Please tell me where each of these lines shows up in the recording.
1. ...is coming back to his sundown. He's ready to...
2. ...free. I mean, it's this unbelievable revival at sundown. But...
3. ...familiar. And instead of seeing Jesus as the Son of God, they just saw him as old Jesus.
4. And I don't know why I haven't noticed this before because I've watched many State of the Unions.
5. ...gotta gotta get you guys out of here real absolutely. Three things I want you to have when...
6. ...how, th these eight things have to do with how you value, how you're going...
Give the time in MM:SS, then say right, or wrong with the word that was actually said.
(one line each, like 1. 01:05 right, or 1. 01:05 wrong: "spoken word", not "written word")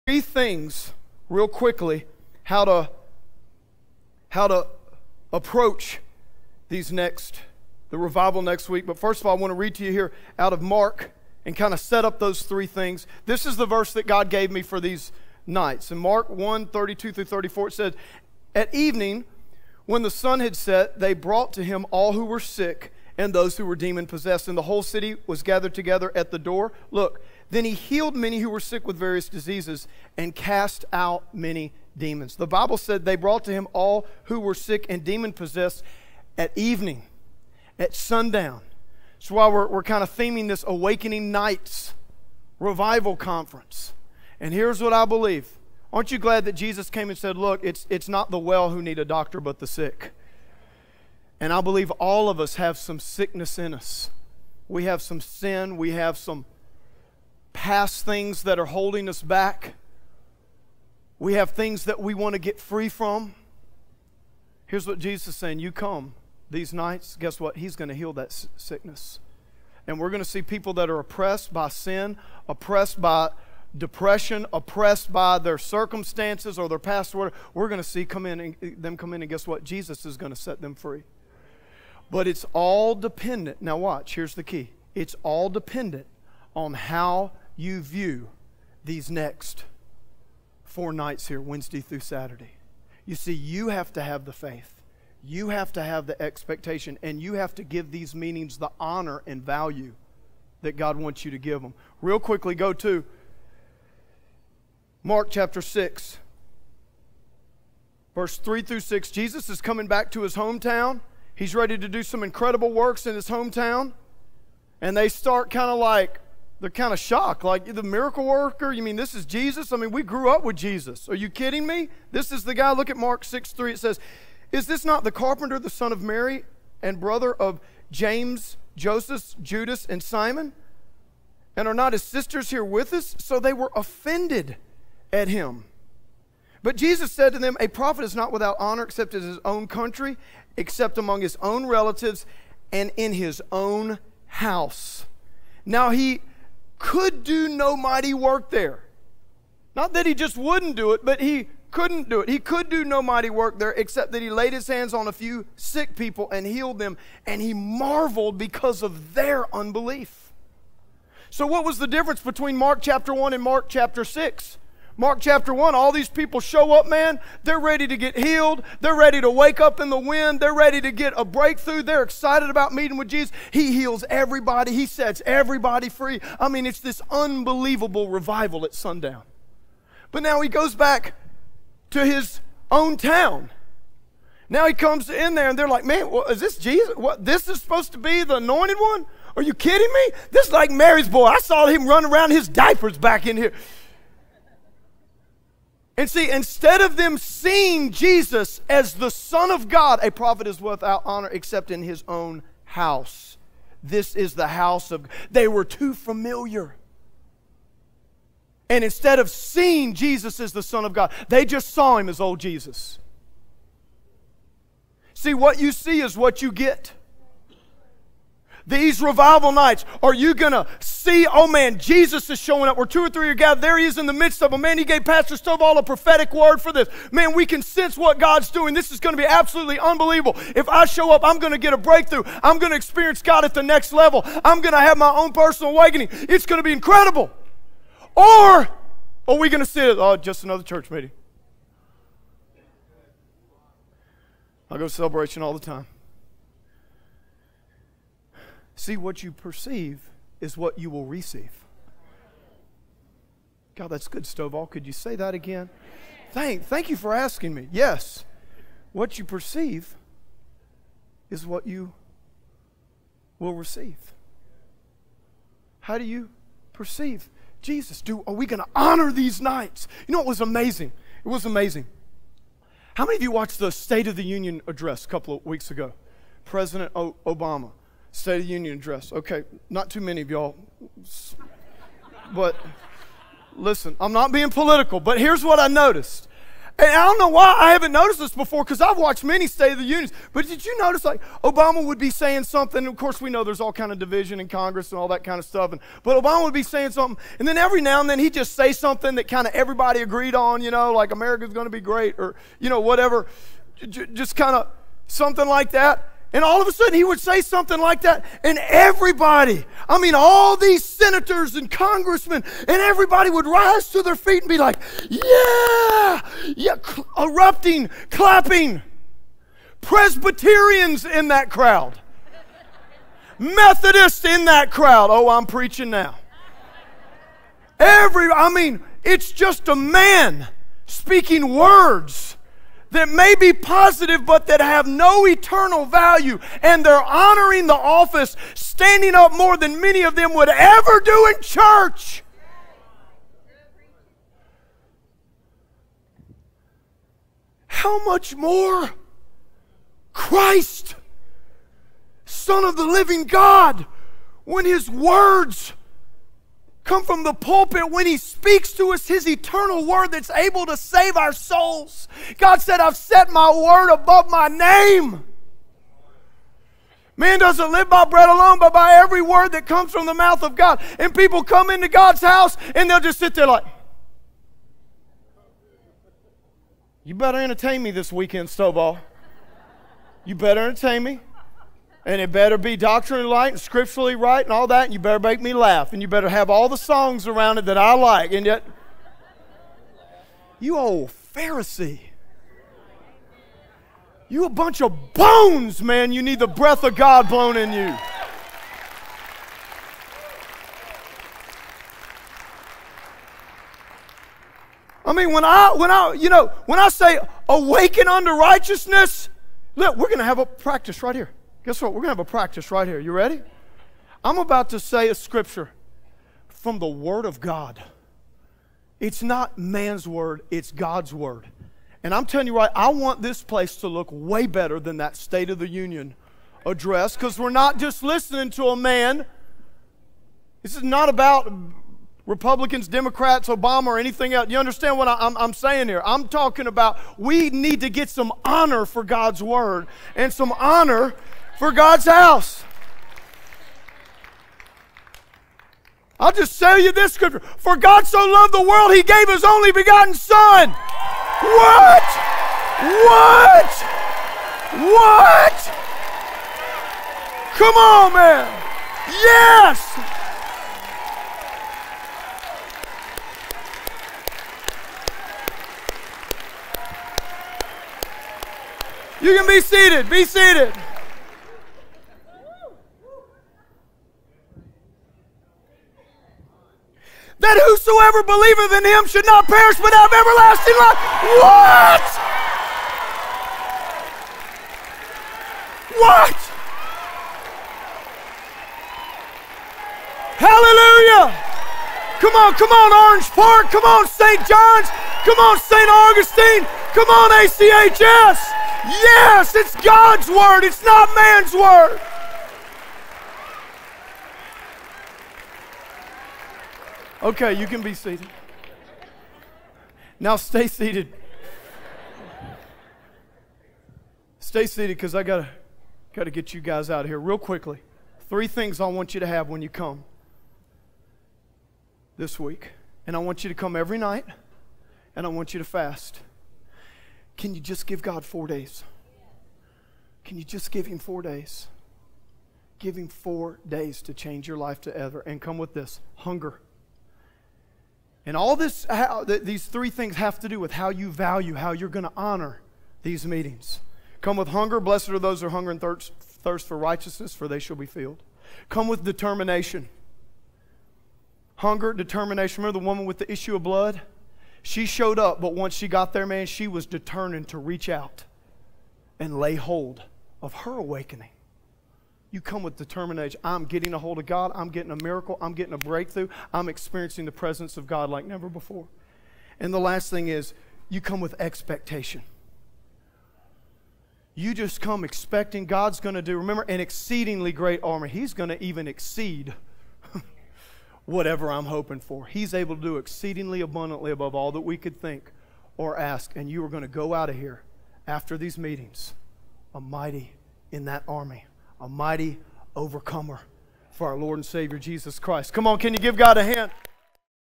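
1. 01:49 wrong: "hometown", not "sundown"
2. 02:55 right
3. 03:25 right
4. 04:46 right
5. 08:35 wrong: "quickly", not "absolutely"
6. 08:58 wrong: "three", not "eight".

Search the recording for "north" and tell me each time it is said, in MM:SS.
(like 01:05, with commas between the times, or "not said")
not said.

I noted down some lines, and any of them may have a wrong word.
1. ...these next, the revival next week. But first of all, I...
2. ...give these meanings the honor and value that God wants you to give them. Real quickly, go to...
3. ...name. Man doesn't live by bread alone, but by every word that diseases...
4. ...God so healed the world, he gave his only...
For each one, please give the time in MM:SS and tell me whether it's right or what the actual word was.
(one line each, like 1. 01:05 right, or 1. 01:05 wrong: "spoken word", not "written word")
1. 00:06 right
2. 01:37 right
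3. 06:04 wrong: "comes", not "diseases"
4. 07:27 wrong: "loved", not "healed".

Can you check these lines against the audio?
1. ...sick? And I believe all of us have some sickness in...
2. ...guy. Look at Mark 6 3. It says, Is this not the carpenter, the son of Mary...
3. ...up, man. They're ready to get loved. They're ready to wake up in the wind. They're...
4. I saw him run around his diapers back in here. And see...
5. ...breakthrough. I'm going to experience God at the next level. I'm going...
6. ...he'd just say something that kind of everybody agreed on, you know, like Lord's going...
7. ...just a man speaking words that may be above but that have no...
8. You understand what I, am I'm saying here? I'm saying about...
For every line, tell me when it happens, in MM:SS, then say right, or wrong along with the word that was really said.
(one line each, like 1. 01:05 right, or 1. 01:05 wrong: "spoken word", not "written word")
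1. 00:49 right
2. 02:02 right
3. 02:46 wrong: "healed", not "loved"
4. 03:11 right
5. 03:51 right
6. 04:58 wrong: "America", not "Lord"
7. 05:29 wrong: "positive", not "above"
8. 07:14 wrong: "talking", not "saying".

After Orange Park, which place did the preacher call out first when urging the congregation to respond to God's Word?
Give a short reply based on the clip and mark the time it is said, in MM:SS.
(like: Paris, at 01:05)
St. John's, at 08:14.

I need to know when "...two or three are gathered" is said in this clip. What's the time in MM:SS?
03:42.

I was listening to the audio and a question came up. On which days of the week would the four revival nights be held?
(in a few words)
Wednesday through Saturday.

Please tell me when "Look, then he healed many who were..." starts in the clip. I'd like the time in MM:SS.
00:26.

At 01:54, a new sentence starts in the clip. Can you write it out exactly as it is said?
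And they start kind of like they're kind of shocked.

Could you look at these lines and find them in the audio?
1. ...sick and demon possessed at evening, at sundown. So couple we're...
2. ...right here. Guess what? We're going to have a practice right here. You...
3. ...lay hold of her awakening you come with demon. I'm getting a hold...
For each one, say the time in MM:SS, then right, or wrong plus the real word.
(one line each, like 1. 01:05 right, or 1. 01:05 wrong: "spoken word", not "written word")
1. 00:34 wrong: "while", not "couple"
2. 06:51 right
3. 09:19 wrong: "determination", not "demon".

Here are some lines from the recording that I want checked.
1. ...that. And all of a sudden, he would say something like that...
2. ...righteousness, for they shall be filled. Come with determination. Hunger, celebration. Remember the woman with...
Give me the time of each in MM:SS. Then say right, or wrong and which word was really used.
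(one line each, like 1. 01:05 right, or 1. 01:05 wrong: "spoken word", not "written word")
1. 05:05 right
2. 09:06 wrong: "determination", not "celebration".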